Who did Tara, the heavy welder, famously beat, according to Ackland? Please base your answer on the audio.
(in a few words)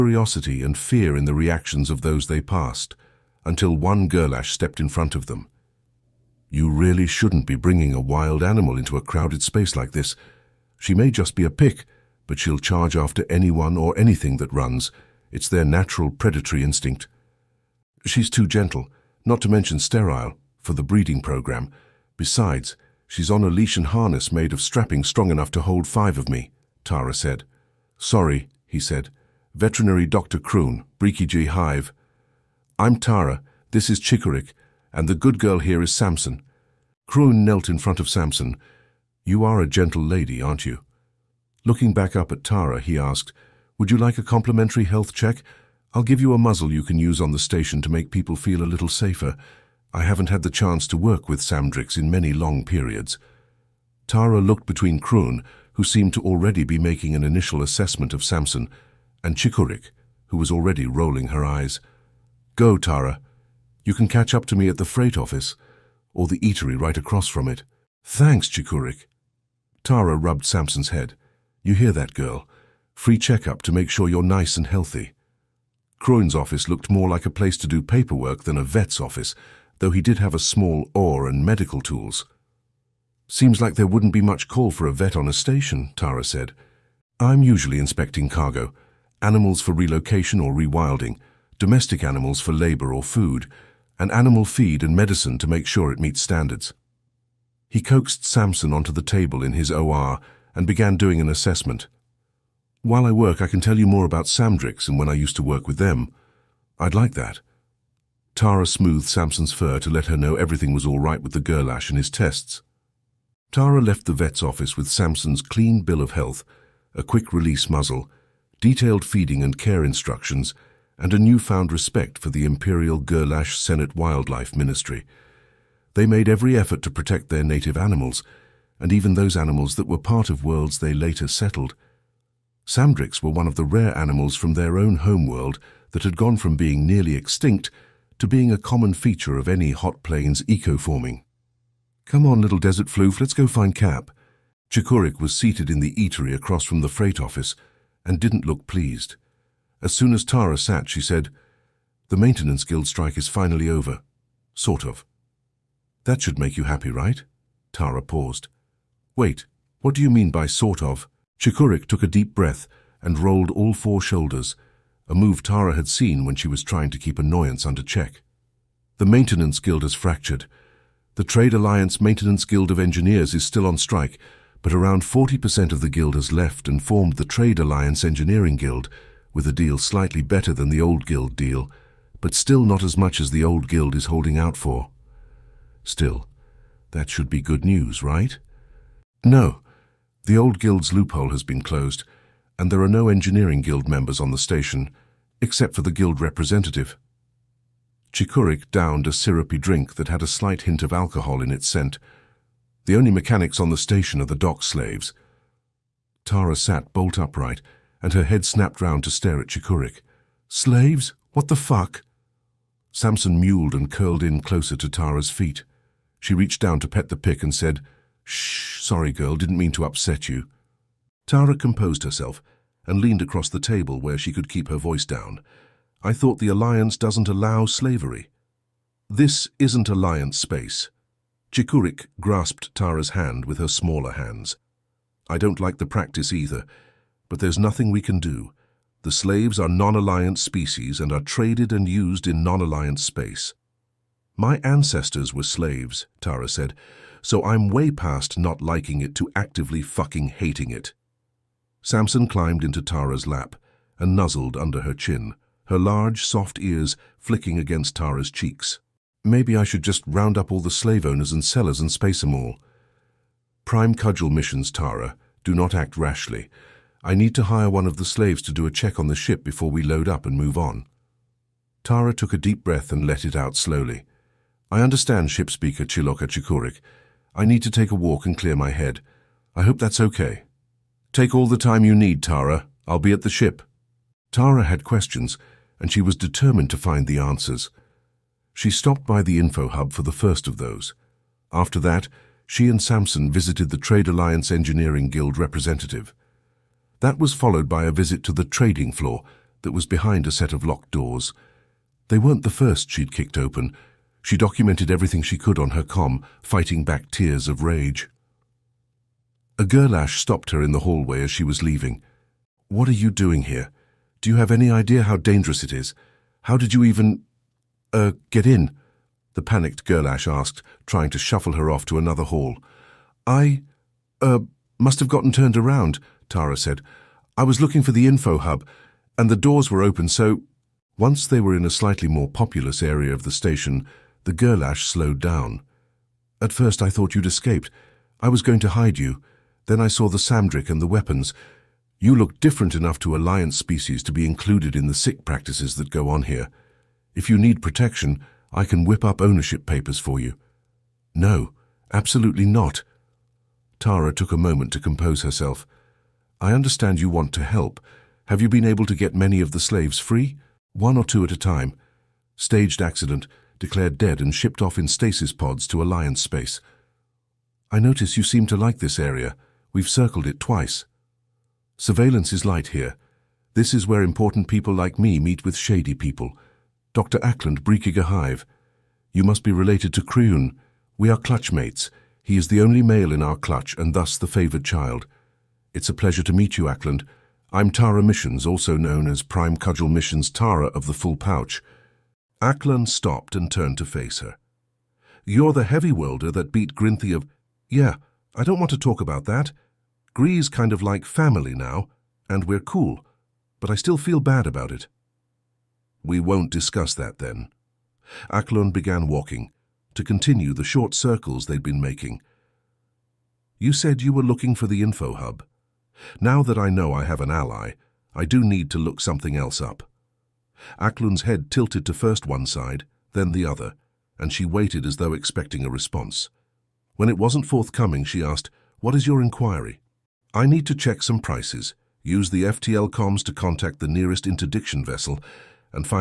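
Grinthy.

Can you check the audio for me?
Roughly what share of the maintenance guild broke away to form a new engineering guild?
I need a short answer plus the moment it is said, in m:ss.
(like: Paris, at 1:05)
40%, at 2:55.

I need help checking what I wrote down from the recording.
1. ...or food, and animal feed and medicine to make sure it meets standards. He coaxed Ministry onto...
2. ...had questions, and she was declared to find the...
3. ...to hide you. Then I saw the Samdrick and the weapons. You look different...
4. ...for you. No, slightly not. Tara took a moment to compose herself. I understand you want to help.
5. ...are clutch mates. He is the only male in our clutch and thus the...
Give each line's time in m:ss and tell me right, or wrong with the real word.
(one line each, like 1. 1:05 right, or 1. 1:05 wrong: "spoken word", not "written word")
1. 1:32 wrong: "Samson", not "Ministry"
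2. 4:44 wrong: "determined", not "declared"
3. 5:38 right
4. 5:49 wrong: "absolutely", not "slightly"
5. 6:21 right.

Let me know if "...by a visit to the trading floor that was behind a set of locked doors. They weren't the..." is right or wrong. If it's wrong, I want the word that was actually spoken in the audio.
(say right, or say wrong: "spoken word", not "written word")
right.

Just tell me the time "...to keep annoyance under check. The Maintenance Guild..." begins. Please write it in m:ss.
2:46.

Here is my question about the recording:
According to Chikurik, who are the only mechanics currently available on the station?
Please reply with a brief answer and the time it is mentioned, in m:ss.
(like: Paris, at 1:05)
dock slaves, at 3:24.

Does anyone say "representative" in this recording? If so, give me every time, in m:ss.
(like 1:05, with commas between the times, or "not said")
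3:16, 4:55.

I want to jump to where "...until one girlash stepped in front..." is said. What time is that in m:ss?
0:03.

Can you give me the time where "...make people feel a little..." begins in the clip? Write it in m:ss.
0:47.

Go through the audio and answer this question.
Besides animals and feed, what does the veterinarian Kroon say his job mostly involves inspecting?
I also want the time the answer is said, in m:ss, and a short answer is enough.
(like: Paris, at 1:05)
cargo, at 1:28.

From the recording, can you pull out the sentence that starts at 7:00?
Aklun's head tilted to first one side, then the other, and she waited as though expecting a response.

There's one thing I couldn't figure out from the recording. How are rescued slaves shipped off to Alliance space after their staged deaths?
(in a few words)
stasis pods.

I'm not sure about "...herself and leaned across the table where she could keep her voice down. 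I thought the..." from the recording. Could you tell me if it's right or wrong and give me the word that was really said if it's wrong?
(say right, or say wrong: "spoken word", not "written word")
right.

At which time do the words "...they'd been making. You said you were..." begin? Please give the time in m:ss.
6:51.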